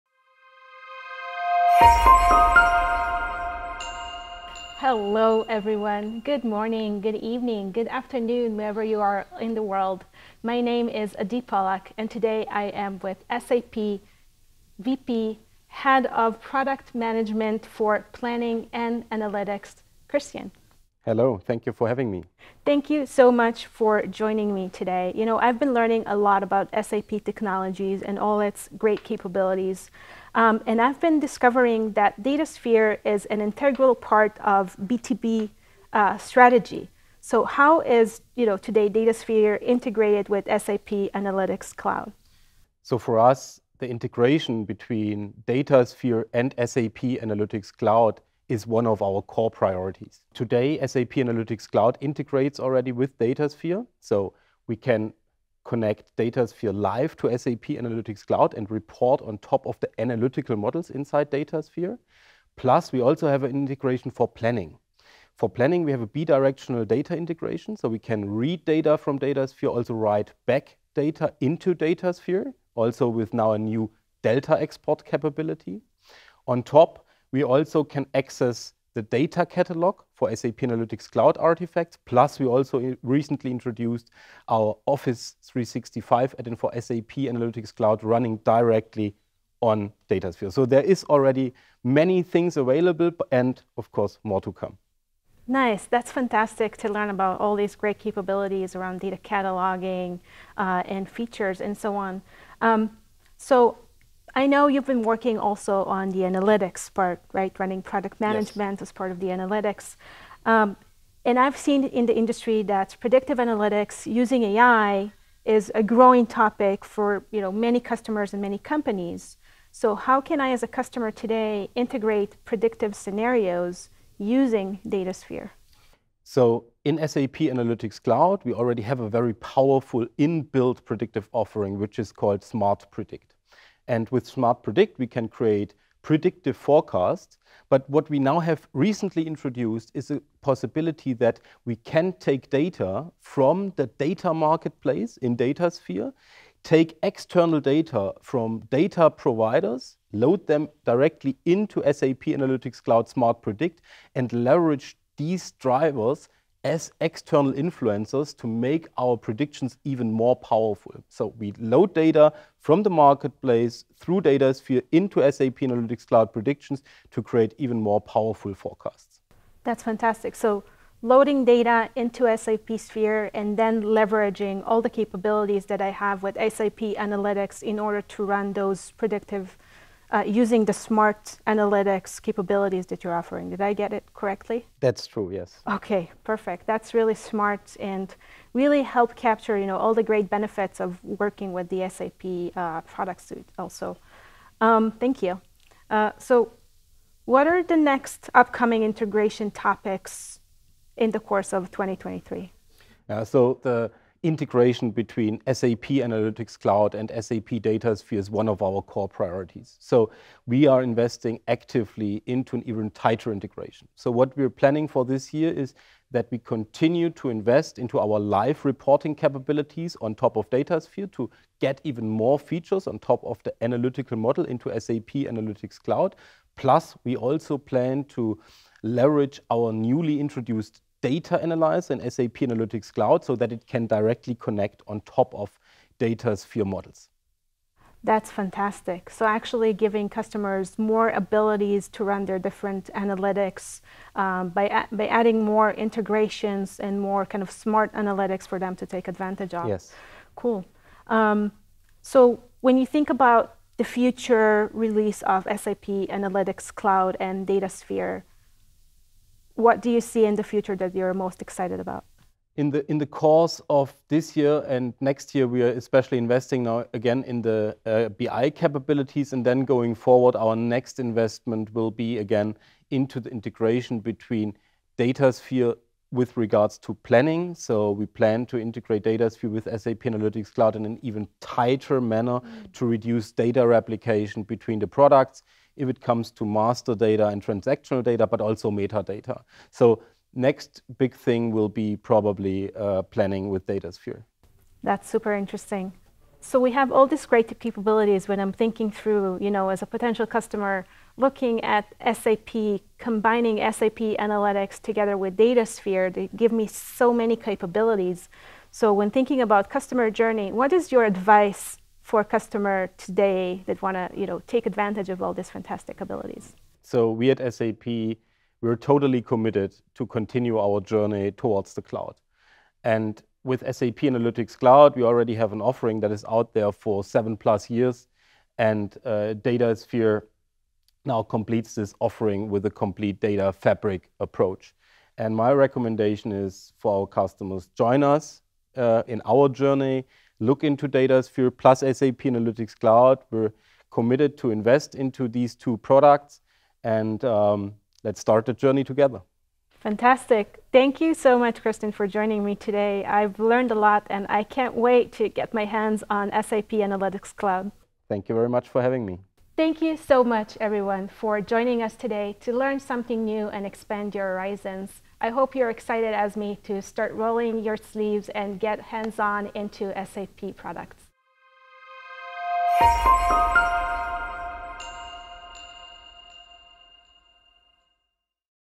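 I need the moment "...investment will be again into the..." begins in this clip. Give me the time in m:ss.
4:30.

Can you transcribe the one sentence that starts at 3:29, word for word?
So we are investing actively into an even tighter integration.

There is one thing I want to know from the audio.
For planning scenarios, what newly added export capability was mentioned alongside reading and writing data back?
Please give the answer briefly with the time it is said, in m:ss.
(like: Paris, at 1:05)
Delta export, at 1:14.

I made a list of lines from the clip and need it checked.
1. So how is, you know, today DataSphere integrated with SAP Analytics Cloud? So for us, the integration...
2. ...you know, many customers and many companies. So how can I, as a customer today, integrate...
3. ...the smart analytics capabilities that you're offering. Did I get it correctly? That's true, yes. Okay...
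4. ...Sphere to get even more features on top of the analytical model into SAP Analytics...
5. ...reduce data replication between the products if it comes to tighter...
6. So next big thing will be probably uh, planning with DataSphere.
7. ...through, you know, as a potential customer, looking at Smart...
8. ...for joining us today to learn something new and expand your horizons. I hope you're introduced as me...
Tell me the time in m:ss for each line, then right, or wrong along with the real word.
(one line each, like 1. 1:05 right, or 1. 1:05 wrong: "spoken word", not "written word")
1. 0:37 right
2. 1:57 right
3. 3:00 right
4. 3:40 right
5. 4:42 wrong: "master", not "tighter"
6. 4:49 right
7. 4:58 wrong: "SAP", not "Smart"
8. 6:01 wrong: "excited", not "introduced".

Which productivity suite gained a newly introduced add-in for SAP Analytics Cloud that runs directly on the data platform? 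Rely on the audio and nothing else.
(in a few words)
Office 365.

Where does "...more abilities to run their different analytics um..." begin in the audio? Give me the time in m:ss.
4:00.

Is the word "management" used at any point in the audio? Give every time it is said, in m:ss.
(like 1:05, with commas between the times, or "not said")
0:16, 1:48.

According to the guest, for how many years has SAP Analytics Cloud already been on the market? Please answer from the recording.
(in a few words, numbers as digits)
7 plus years.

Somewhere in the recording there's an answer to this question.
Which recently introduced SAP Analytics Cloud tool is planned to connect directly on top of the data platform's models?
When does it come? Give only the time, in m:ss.
3:51.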